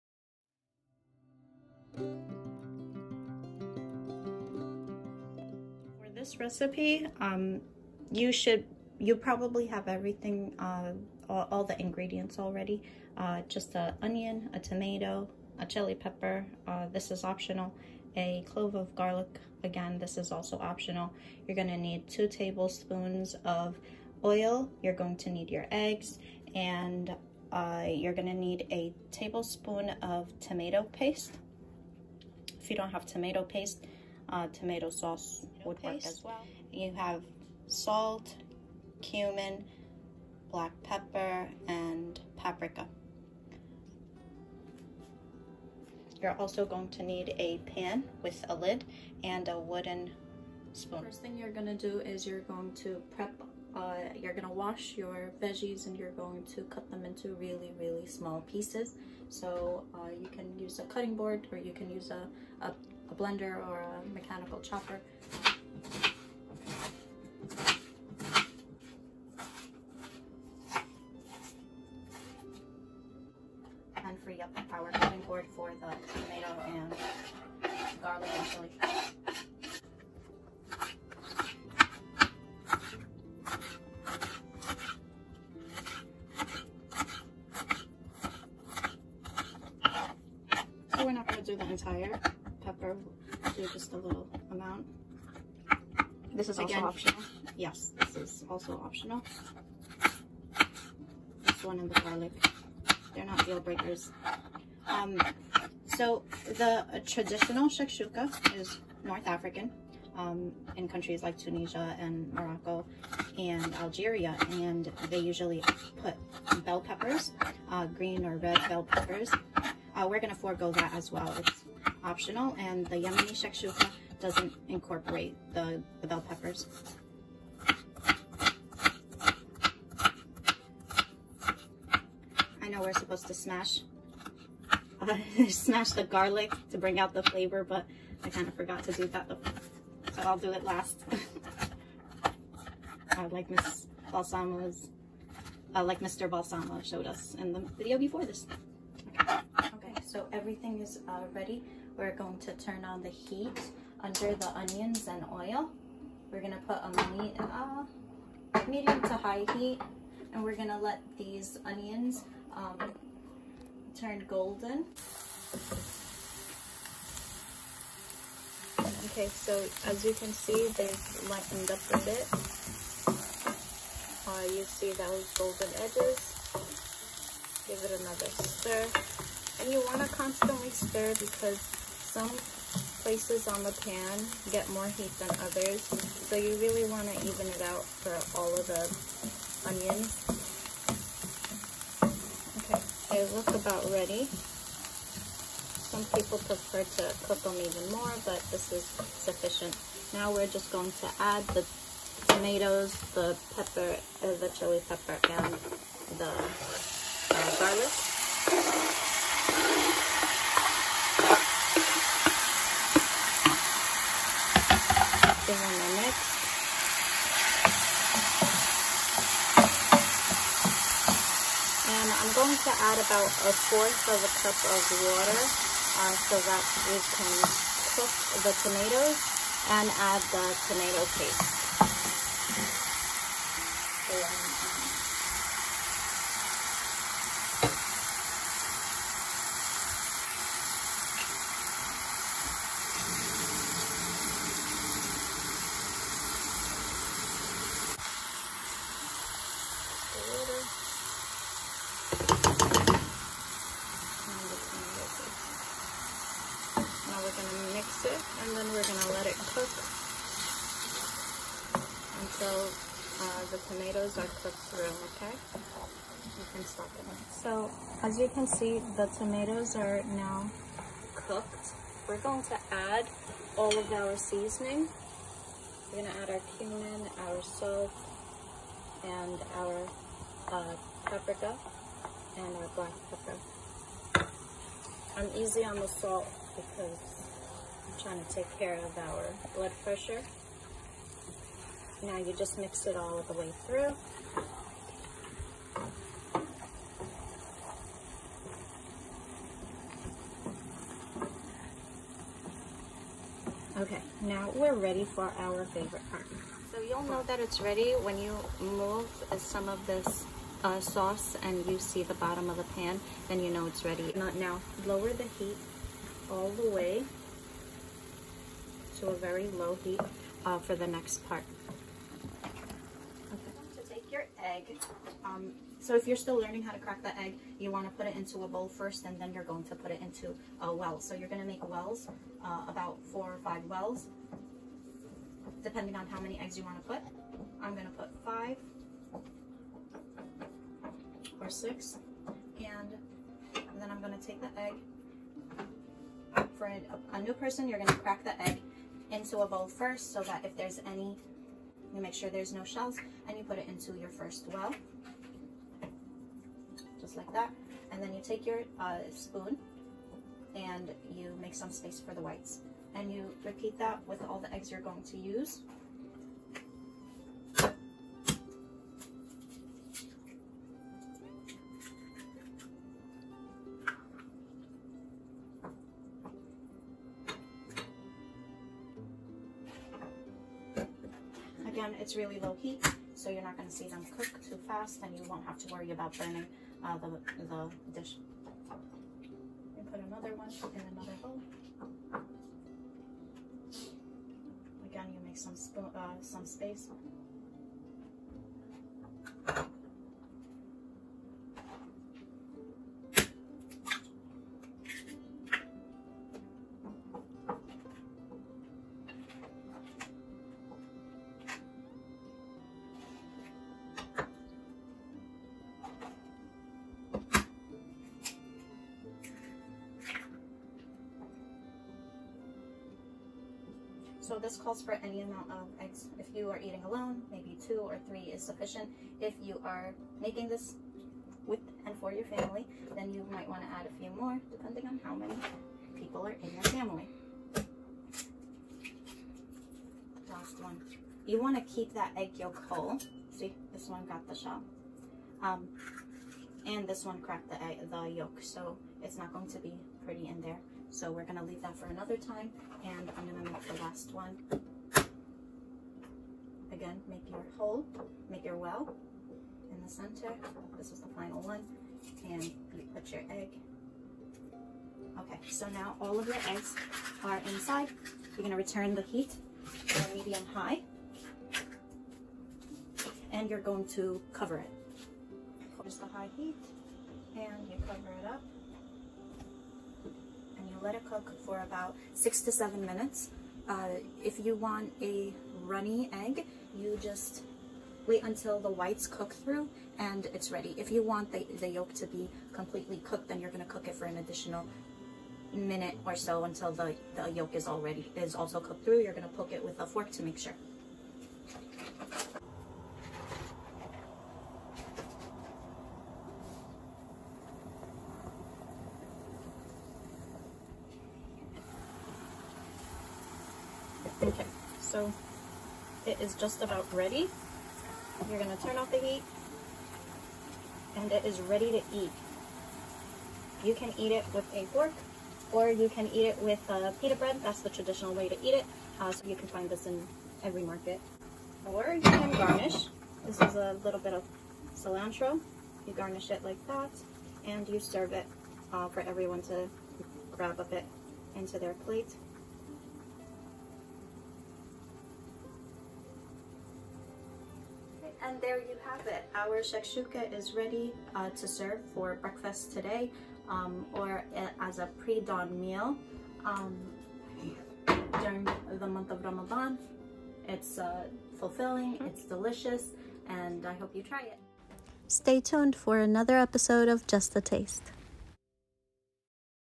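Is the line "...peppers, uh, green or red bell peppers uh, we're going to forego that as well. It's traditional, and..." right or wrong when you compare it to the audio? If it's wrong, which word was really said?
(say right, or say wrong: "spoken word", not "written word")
wrong: "optional", not "traditional".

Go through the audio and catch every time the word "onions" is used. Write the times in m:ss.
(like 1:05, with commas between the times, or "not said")
0:14, 2:34, 2:41, 3:09.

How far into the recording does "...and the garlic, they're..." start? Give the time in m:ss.
1:41.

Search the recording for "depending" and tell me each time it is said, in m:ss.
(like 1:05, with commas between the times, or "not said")
5:35, 7:14.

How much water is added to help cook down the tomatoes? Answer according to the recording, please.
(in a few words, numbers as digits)
a fourth of a cup.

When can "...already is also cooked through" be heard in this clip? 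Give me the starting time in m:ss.
8:17.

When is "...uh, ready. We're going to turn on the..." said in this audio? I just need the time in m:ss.
2:31.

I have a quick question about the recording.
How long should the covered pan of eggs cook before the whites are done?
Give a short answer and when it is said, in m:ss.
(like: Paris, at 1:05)
6 to 7 minutes, at 8:02.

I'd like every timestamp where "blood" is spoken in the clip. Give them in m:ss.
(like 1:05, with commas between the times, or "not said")
4:49.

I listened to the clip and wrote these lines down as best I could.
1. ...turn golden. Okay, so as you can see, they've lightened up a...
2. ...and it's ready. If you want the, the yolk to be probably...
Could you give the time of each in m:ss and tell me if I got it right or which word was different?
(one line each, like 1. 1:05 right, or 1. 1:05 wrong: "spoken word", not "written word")
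1. 2:43 right
2. 8:09 wrong: "completely", not "probably".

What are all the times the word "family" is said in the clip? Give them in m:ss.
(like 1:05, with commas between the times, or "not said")
7:12, 7:16.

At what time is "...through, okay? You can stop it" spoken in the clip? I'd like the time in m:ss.
4:24.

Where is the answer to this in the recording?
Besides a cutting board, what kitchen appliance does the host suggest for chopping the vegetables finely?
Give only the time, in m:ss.
1:03.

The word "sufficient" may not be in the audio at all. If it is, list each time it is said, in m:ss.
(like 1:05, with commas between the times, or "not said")
3:18, 7:08.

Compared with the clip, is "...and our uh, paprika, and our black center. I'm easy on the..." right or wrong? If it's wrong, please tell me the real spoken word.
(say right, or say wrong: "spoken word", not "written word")
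wrong: "pepper", not "center".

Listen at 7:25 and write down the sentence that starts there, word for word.
Um, and this one cracked the, egg, the yolk, so it's not going to be pretty in there.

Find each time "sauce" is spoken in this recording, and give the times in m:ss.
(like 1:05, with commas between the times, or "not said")
0:34, 5:10.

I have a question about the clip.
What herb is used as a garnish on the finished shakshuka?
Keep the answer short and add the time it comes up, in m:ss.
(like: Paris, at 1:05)
cilantro, at 8:54.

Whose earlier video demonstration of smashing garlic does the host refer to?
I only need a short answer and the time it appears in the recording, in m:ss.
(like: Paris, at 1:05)
Mr. Balsamo, at 2:25.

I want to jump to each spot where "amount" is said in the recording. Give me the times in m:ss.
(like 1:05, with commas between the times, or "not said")
1:34, 7:05.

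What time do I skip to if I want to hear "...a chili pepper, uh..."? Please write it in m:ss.
0:15.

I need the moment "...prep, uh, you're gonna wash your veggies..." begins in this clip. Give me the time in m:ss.
0:53.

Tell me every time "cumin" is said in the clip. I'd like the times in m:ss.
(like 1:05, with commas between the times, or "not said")
0:39, 4:36.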